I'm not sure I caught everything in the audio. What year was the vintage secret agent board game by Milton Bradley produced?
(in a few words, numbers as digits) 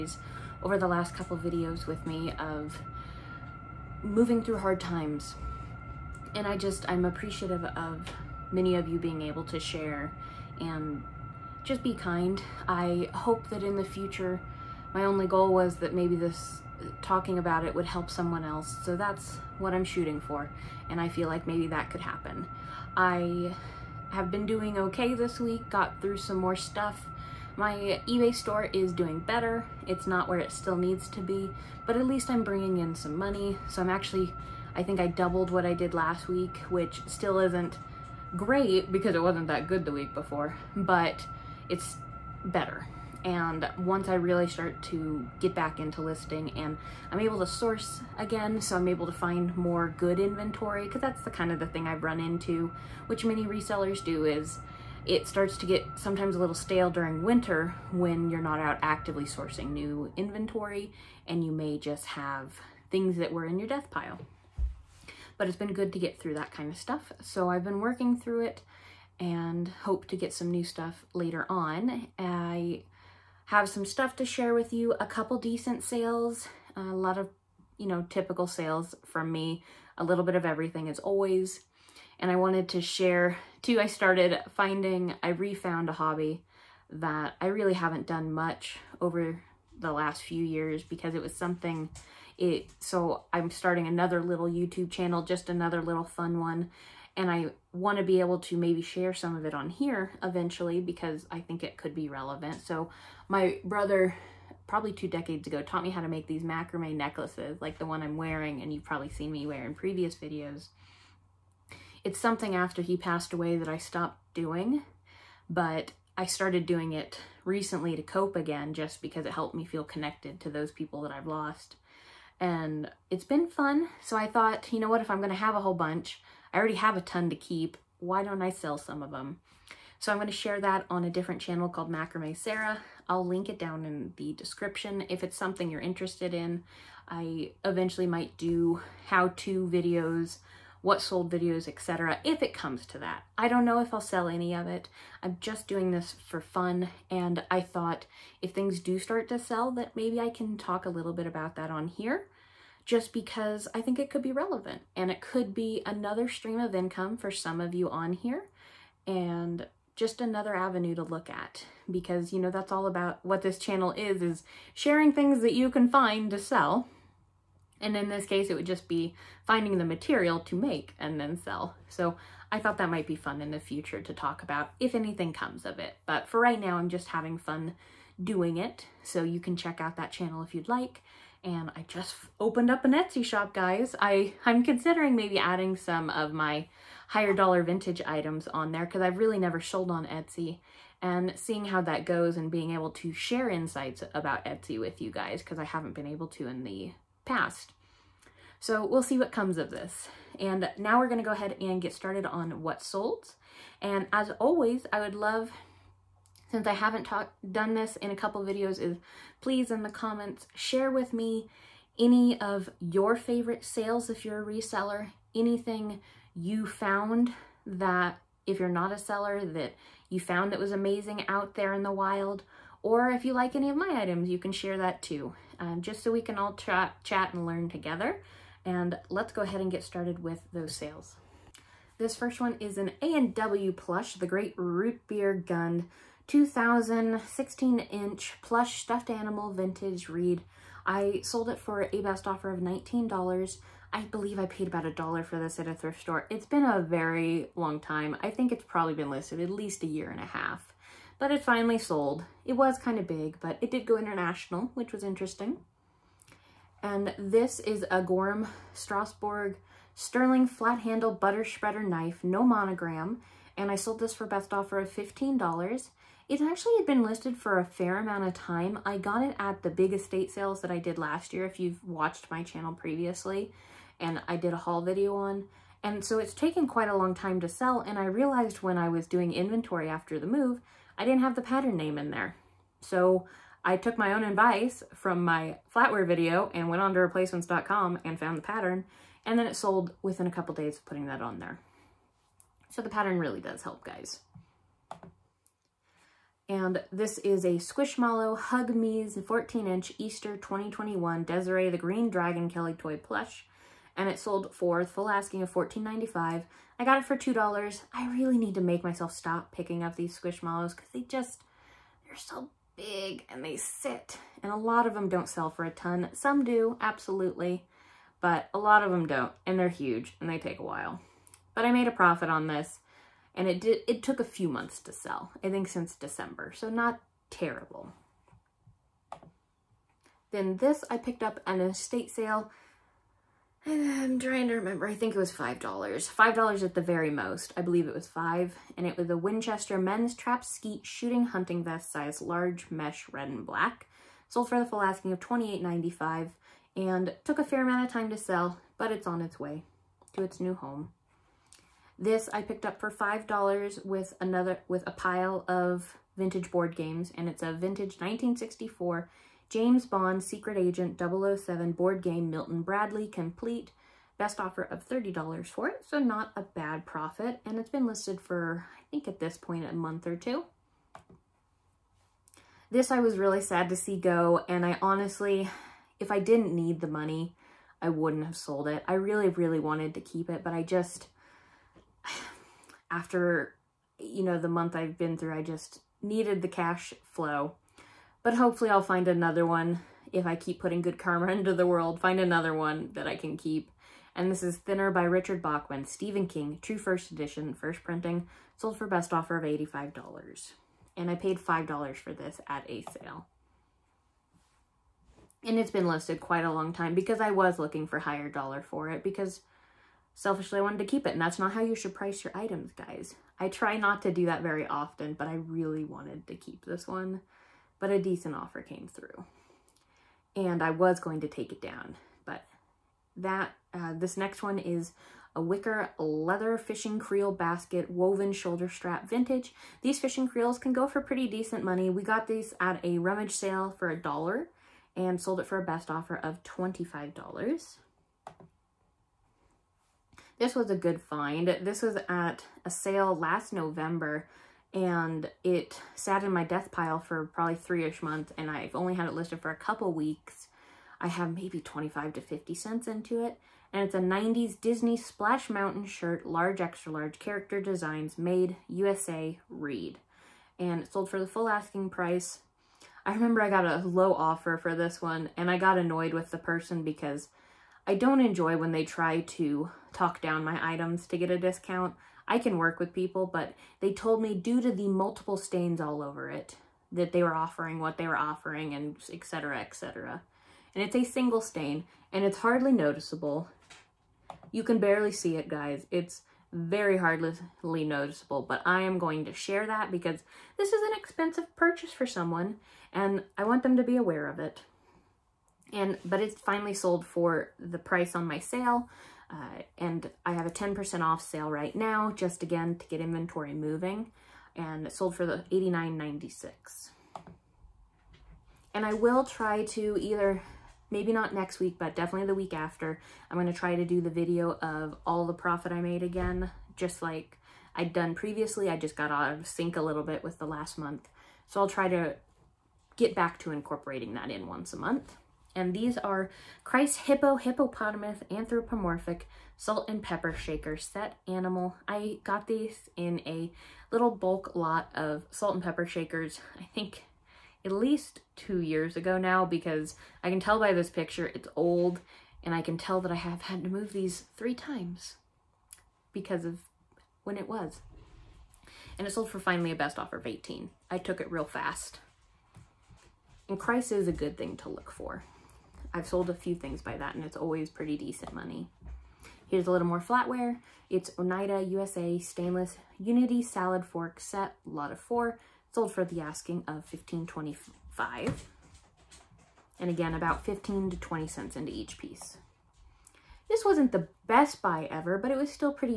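1964.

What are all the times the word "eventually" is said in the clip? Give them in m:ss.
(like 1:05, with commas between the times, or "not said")
1:40, 2:17.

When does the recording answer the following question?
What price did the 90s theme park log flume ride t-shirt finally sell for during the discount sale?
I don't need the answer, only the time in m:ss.
8:25.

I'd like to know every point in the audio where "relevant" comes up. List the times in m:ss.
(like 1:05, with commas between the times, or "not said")
1:42, 2:34.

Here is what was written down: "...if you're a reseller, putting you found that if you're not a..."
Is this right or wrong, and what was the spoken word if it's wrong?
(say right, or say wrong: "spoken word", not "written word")
wrong: "anything", not "putting".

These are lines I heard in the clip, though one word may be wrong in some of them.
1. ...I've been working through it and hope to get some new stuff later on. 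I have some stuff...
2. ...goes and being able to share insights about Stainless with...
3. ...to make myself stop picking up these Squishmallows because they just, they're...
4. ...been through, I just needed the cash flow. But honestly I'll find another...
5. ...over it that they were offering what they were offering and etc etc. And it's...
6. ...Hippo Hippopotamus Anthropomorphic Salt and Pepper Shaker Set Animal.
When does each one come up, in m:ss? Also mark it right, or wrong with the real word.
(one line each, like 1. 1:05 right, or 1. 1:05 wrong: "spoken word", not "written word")
1. 1:07 right
2. 3:12 wrong: "Etsy", not "Stainless"
3. 5:08 right
4. 6:24 wrong: "hopefully", not "honestly"
5. 7:56 right
6. 8:46 right.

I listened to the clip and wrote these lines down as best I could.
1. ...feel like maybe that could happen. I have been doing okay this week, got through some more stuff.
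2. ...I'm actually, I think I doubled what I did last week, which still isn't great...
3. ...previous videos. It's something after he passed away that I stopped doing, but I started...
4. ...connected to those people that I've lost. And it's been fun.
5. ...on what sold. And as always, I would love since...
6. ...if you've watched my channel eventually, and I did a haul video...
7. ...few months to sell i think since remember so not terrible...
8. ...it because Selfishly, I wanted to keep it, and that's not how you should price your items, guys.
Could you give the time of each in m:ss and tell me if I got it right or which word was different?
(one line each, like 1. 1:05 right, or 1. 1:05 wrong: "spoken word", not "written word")
1. 0:21 right
2. 0:33 right
3. 1:49 right
4. 1:59 right
5. 3:22 right
6. 4:31 wrong: "previously", not "eventually"
7. 5:24 wrong: "december", not "remember"
8. 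6:48 right.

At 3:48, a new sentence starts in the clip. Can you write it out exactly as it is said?
And let's go ahead and get started with those sales.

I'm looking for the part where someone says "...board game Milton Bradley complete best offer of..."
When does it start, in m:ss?
6:01.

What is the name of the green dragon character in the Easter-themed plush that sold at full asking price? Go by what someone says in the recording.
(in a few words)
Desiree.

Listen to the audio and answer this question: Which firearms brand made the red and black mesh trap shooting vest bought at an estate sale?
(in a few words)
Winchester.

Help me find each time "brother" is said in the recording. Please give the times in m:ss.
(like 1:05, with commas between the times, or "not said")
1:43.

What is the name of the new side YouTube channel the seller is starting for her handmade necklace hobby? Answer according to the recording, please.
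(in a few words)
Macrame Sarah.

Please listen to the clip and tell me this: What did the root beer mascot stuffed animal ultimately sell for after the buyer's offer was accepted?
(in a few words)
$19.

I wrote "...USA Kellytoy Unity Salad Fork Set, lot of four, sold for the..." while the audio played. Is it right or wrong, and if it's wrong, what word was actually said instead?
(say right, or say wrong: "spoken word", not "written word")
wrong: "Stainless", not "Kellytoy".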